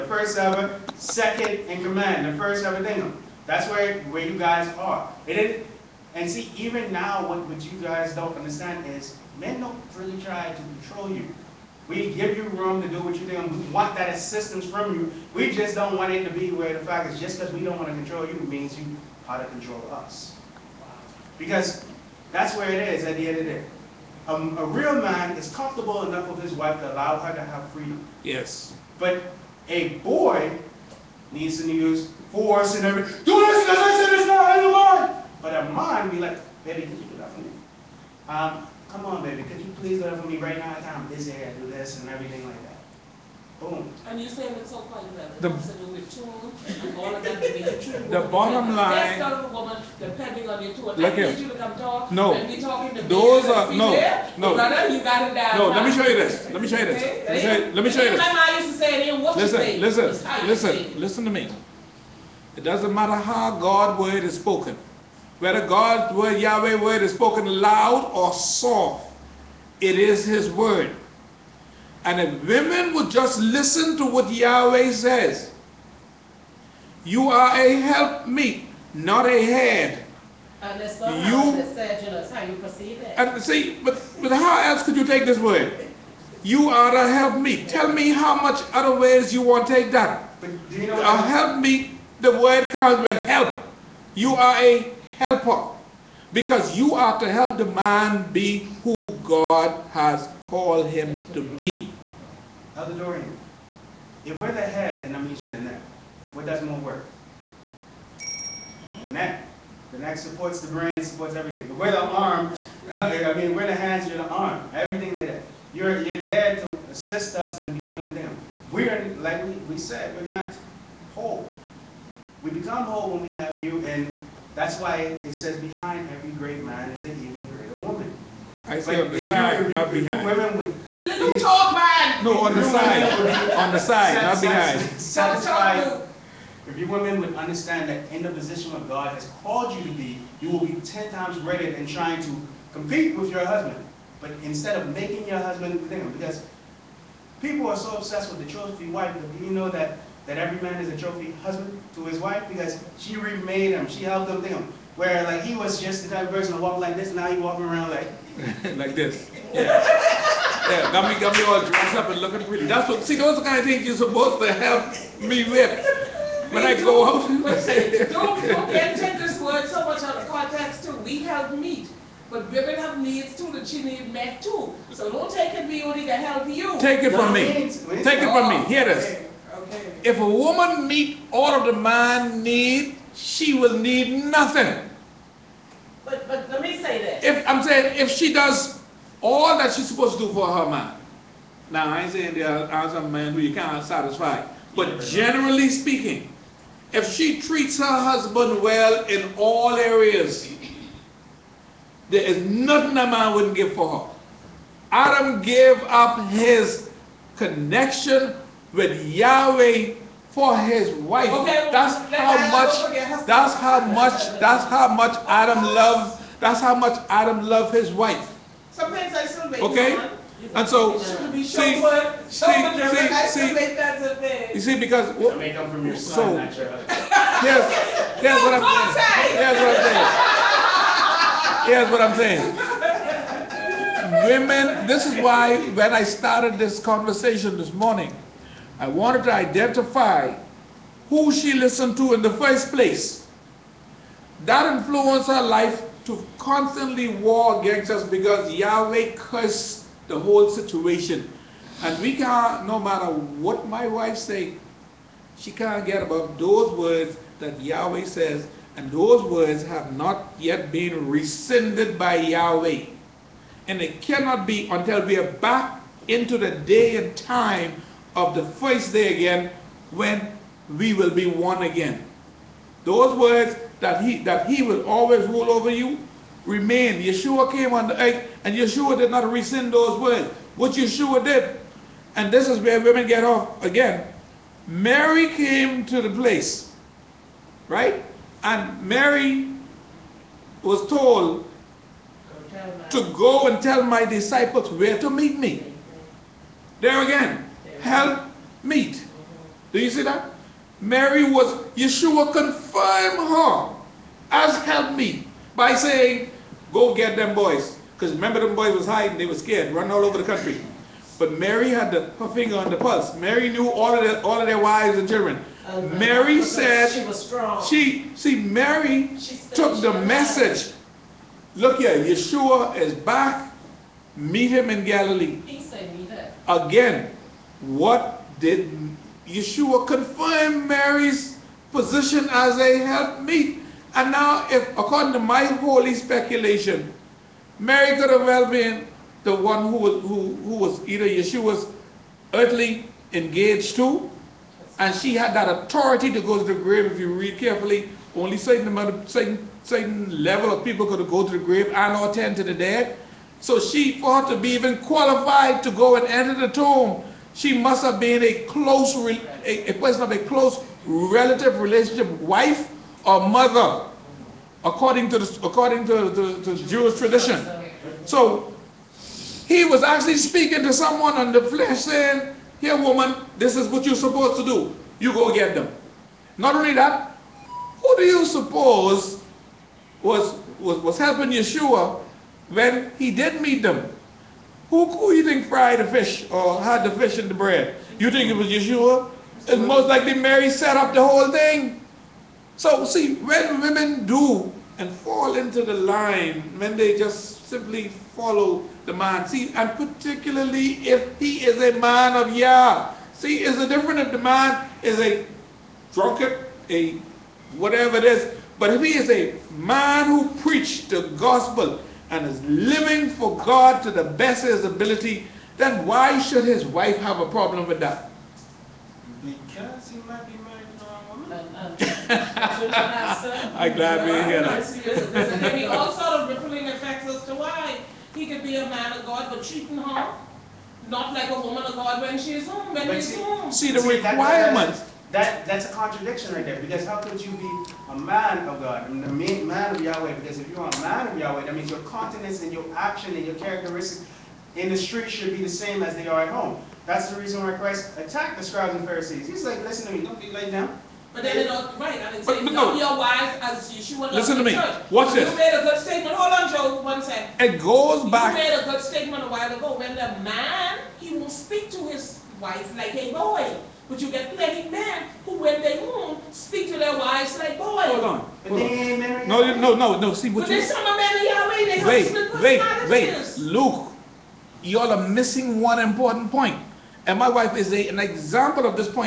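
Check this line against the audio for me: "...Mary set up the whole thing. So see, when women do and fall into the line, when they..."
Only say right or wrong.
right.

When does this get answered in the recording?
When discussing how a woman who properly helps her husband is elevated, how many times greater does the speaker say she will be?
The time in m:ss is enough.
2:20.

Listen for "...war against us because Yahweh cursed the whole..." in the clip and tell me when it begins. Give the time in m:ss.
4:07.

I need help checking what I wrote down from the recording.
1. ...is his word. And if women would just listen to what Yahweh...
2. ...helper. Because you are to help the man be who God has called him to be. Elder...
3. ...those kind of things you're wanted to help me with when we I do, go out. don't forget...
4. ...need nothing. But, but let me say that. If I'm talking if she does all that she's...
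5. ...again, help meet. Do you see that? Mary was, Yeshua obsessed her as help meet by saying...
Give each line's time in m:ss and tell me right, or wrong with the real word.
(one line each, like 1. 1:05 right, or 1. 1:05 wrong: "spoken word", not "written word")
1. 1:09 right
2. 1:35 right
3. 2:43 wrong: "supposed", not "wanted"
4. 3:03 wrong: "saying", not "talking"
5. 4:57 wrong: "confirmed", not "obsessed".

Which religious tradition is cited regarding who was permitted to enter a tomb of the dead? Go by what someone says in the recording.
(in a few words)
Jewish tradition.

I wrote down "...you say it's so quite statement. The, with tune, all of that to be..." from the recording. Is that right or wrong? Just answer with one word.
wrong.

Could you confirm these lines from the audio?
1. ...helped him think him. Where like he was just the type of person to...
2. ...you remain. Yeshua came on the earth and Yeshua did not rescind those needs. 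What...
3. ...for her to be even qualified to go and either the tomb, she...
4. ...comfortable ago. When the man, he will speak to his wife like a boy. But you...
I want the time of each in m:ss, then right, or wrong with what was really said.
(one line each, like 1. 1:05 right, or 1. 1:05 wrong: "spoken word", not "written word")
1. 2:34 right
2. 4:35 wrong: "words", not "needs"
3. 5:54 wrong: "enter", not "either"
4. 7:39 wrong: "while", not "comfortable".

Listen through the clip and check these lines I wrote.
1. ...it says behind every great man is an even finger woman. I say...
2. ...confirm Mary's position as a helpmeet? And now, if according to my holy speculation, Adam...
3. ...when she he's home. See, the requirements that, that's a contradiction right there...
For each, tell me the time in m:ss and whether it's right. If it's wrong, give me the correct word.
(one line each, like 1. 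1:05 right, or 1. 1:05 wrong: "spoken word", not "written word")
1. 2:04 wrong: "greater", not "finger"
2. 5:29 wrong: "Mary", not "Adam"
3. 7:12 right.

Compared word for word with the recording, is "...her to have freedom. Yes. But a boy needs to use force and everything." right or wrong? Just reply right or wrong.
right.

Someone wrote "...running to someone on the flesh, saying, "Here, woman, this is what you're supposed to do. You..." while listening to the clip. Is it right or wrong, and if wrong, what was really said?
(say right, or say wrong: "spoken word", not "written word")
wrong: "speaking", not "running".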